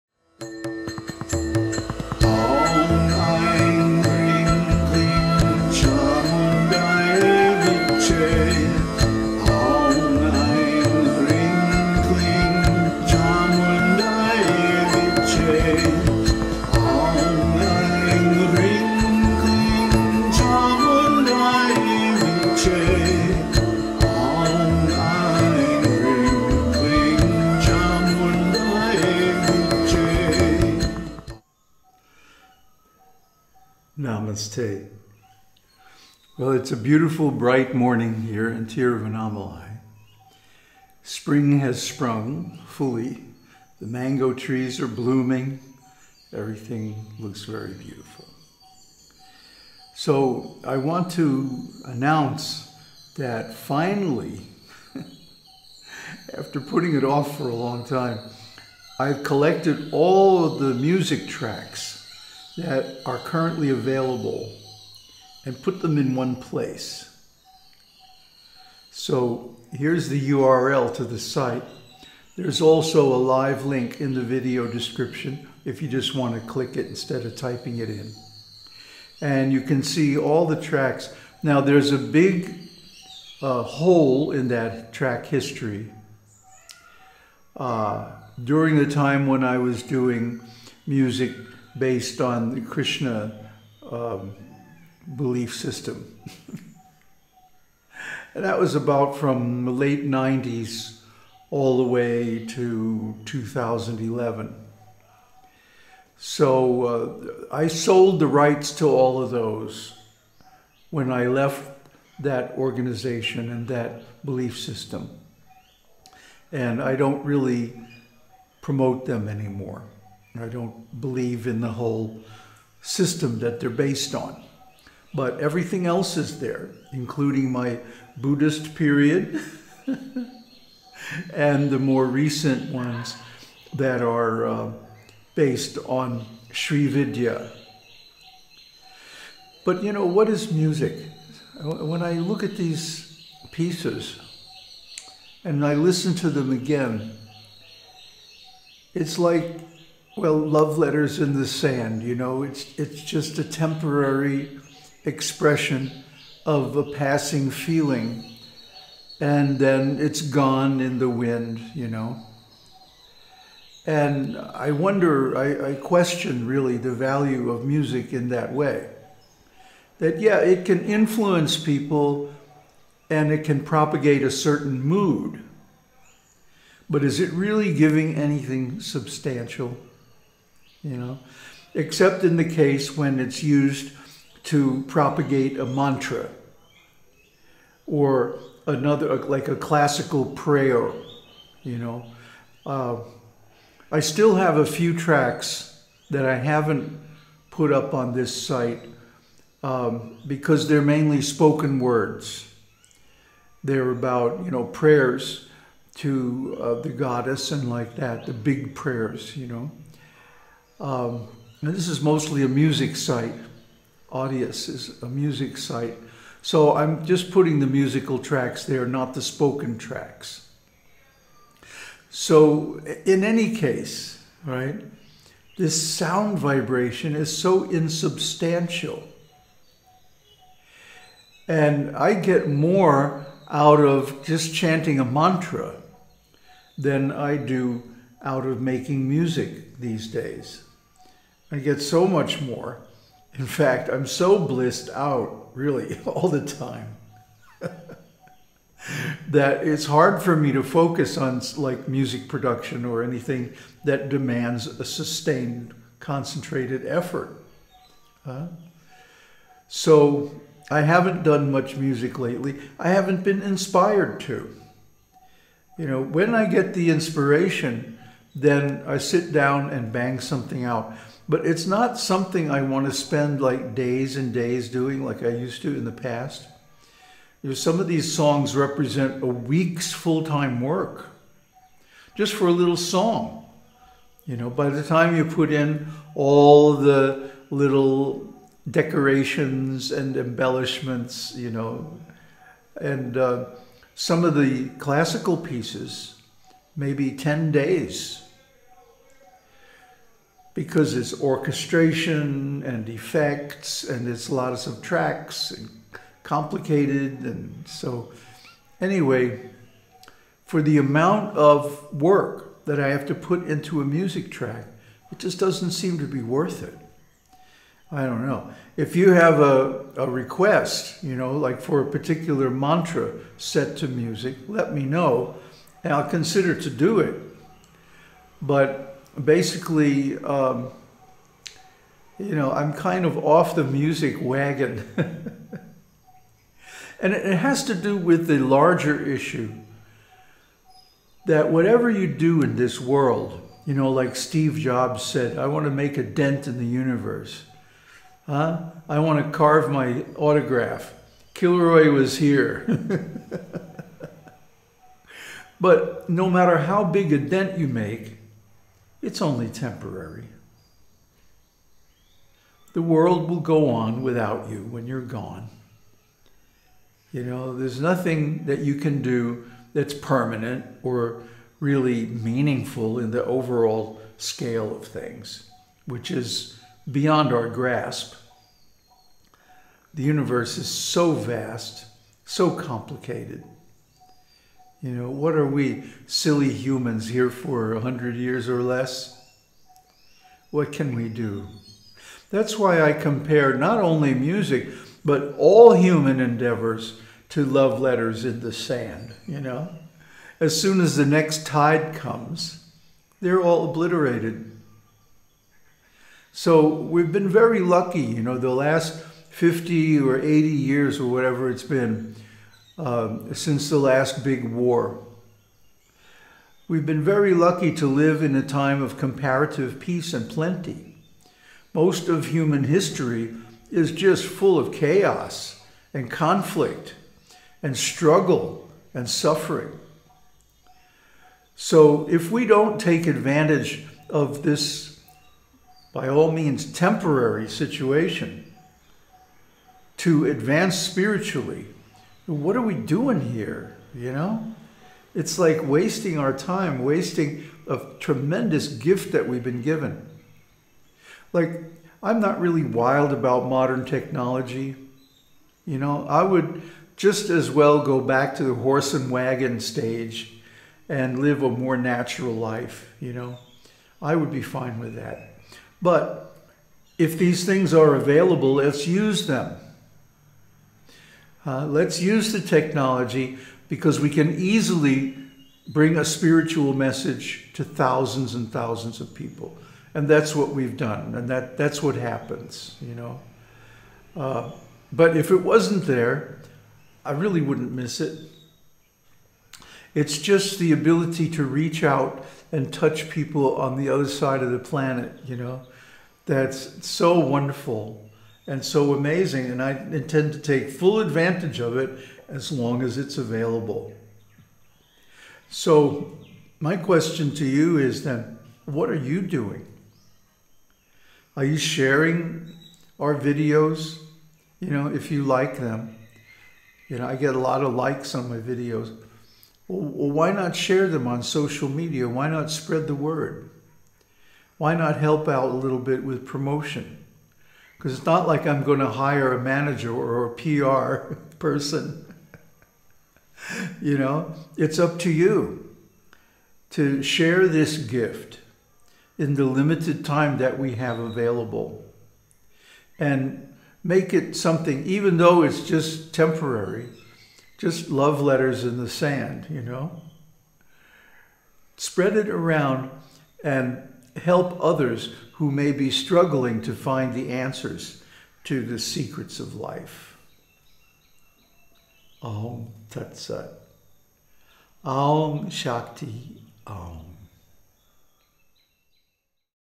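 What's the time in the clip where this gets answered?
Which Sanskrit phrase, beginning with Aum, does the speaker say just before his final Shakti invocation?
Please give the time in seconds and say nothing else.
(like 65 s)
562 s.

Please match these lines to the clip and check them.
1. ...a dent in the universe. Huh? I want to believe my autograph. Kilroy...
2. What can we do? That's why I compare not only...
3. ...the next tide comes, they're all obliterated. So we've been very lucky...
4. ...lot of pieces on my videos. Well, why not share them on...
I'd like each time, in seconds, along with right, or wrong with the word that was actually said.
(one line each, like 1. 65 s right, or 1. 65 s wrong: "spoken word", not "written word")
1. 345 s wrong: "carve", not "believe"
2. 390 s right
3. 400 s right
4. 517 s wrong: "likes", not "pieces".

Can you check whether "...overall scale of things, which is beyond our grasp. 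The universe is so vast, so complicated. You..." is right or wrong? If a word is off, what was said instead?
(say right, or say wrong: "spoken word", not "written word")
right.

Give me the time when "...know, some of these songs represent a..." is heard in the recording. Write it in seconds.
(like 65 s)
277 s.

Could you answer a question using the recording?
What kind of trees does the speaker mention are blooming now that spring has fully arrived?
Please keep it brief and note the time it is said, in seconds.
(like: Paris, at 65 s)
Mango, at 43 s.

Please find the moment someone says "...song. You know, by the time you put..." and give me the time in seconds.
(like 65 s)
282 s.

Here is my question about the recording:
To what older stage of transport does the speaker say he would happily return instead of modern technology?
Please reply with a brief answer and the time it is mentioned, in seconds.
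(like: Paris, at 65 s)
Horse and wagon, at 458 s.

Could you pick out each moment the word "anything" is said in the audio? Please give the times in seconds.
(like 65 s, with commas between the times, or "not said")
178 s, 253 s.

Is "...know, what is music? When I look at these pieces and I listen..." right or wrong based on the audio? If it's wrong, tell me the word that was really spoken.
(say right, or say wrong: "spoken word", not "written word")
right.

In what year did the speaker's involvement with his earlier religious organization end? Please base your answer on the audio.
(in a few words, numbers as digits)
2011.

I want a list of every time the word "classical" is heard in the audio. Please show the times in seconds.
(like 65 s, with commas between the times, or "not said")
189 s, 294 s.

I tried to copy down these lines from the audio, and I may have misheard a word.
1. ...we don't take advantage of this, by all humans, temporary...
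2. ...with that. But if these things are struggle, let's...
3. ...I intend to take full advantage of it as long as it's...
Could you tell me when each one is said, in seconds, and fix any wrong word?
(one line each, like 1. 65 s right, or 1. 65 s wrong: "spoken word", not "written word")
1. 432 s wrong: "means", not "humans"
2. 464 s wrong: "available", not "struggle"
3. 499 s right.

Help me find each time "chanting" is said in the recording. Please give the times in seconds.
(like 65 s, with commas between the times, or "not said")
234 s.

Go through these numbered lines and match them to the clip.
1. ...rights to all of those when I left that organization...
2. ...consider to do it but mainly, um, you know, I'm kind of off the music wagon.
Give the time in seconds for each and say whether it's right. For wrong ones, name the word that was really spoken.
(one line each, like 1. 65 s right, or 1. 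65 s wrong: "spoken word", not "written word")
1. 108 s right
2. 326 s wrong: "basically", not "mainly".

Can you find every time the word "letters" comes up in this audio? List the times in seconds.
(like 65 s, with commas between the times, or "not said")
150 s, 397 s, 548 s.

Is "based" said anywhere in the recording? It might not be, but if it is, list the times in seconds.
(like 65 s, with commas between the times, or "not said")
91 s, 123 s, 135 s.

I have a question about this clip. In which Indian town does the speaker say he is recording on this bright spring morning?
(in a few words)
Tiruvannamalai.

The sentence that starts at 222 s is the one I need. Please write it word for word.
So in any case, right, this sound vibration is so insubstantial.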